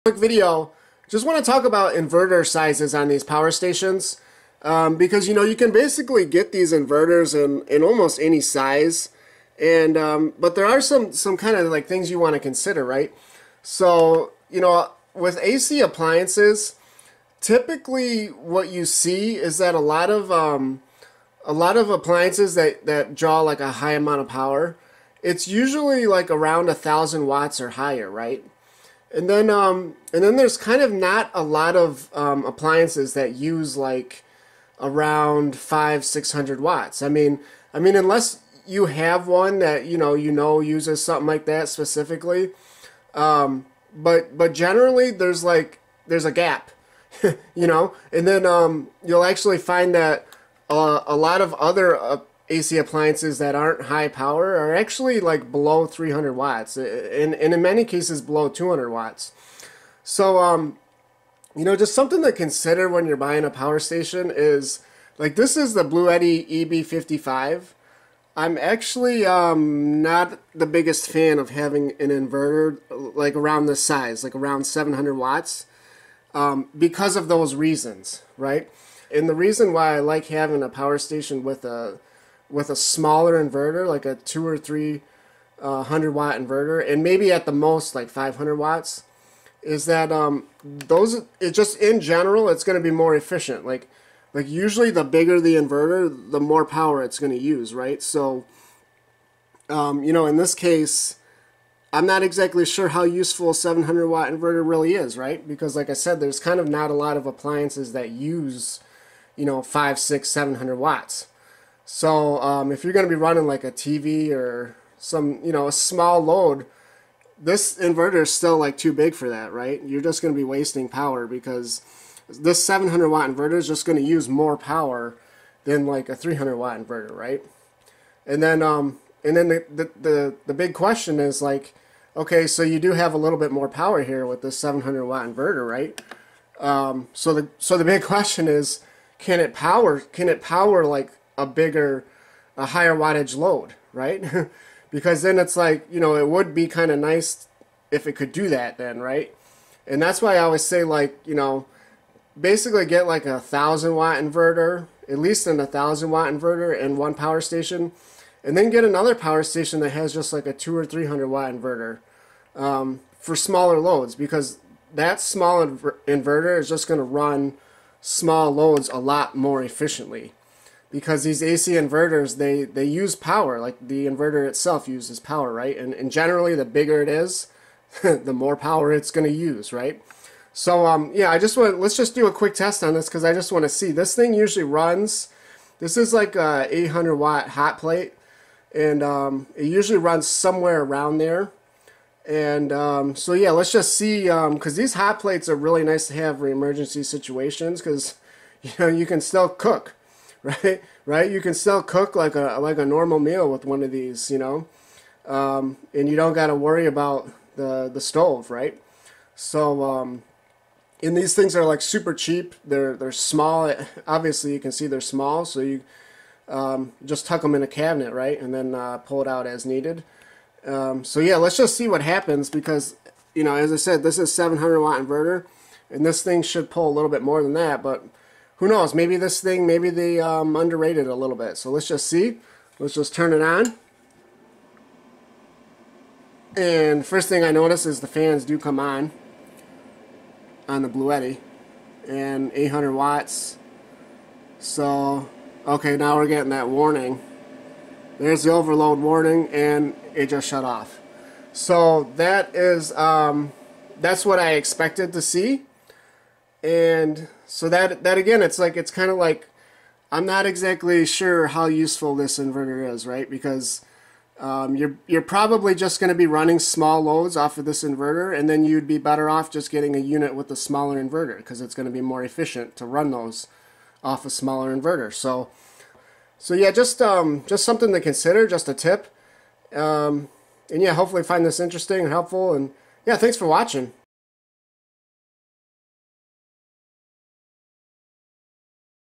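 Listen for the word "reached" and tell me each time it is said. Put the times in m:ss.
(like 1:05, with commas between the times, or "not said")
not said.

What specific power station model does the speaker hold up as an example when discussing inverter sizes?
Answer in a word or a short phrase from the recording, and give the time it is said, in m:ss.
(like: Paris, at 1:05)
Bluetti EB55, at 1:05.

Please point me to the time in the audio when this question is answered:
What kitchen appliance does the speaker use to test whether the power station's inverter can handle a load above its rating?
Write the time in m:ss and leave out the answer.
3:07.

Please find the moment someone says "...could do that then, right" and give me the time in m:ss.
2:28.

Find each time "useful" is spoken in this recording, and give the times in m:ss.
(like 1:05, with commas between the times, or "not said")
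1:43, 4:21.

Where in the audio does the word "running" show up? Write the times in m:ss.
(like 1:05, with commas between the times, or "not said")
1:53, 4:26.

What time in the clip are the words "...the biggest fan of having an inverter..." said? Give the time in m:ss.
1:10.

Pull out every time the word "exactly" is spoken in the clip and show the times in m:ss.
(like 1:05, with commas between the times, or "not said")
1:42, 4:20.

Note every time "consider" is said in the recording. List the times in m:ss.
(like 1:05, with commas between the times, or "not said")
0:12, 1:02, 4:37.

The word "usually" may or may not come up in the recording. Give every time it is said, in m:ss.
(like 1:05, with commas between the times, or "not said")
0:25, 1:34, 3:04, 3:09.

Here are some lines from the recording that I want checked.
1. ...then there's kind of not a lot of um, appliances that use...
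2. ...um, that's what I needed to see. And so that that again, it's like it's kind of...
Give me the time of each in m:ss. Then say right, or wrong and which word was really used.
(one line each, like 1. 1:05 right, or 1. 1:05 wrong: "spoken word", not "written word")
1. 0:30 right
2. 4:12 wrong: "expected", not "needed".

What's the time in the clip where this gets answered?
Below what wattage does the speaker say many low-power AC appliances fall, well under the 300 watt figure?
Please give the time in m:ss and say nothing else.
0:58.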